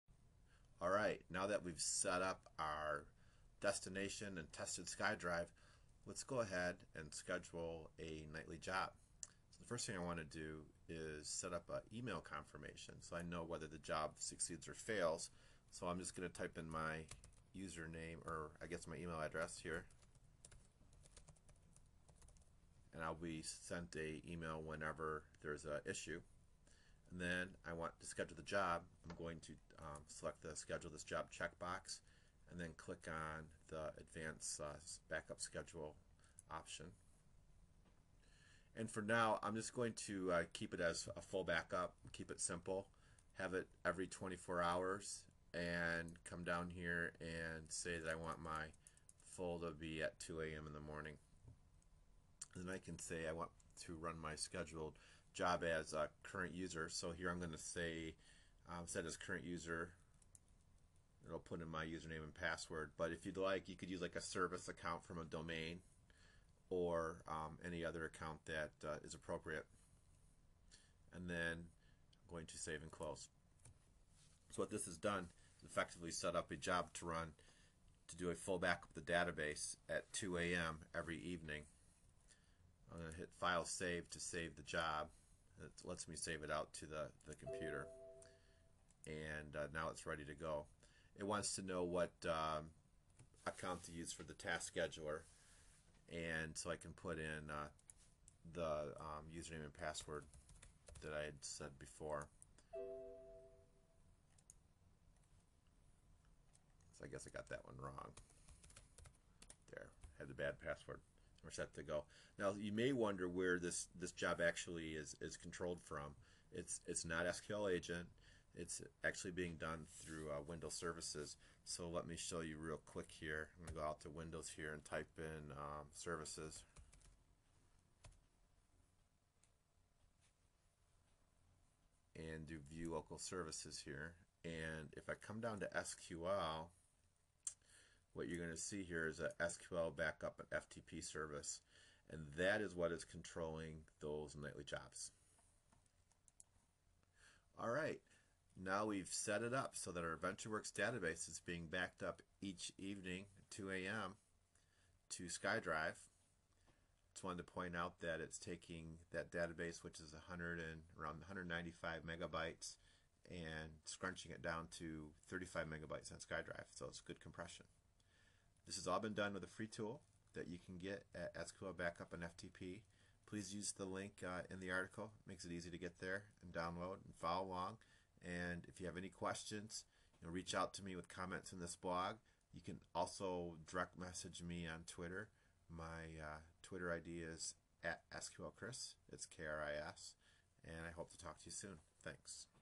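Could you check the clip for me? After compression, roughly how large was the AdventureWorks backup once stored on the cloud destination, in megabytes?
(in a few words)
35 megabytes.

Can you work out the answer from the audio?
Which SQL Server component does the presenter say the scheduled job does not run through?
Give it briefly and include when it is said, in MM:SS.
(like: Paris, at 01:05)
SQL agent, at 01:57.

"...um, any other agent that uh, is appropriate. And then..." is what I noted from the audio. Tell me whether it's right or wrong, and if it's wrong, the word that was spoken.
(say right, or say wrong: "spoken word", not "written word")
wrong: "account", not "agent".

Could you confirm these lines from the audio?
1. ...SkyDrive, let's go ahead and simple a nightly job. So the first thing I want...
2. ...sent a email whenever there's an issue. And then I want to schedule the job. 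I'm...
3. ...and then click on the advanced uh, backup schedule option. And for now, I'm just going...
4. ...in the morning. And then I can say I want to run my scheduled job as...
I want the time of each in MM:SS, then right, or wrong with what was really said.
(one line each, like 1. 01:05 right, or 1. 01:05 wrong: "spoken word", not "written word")
1. 00:04 wrong: "schedule", not "simple"
2. 00:23 right
3. 00:32 right
4. 00:50 right.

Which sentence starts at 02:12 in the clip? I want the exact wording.
And do view local services here.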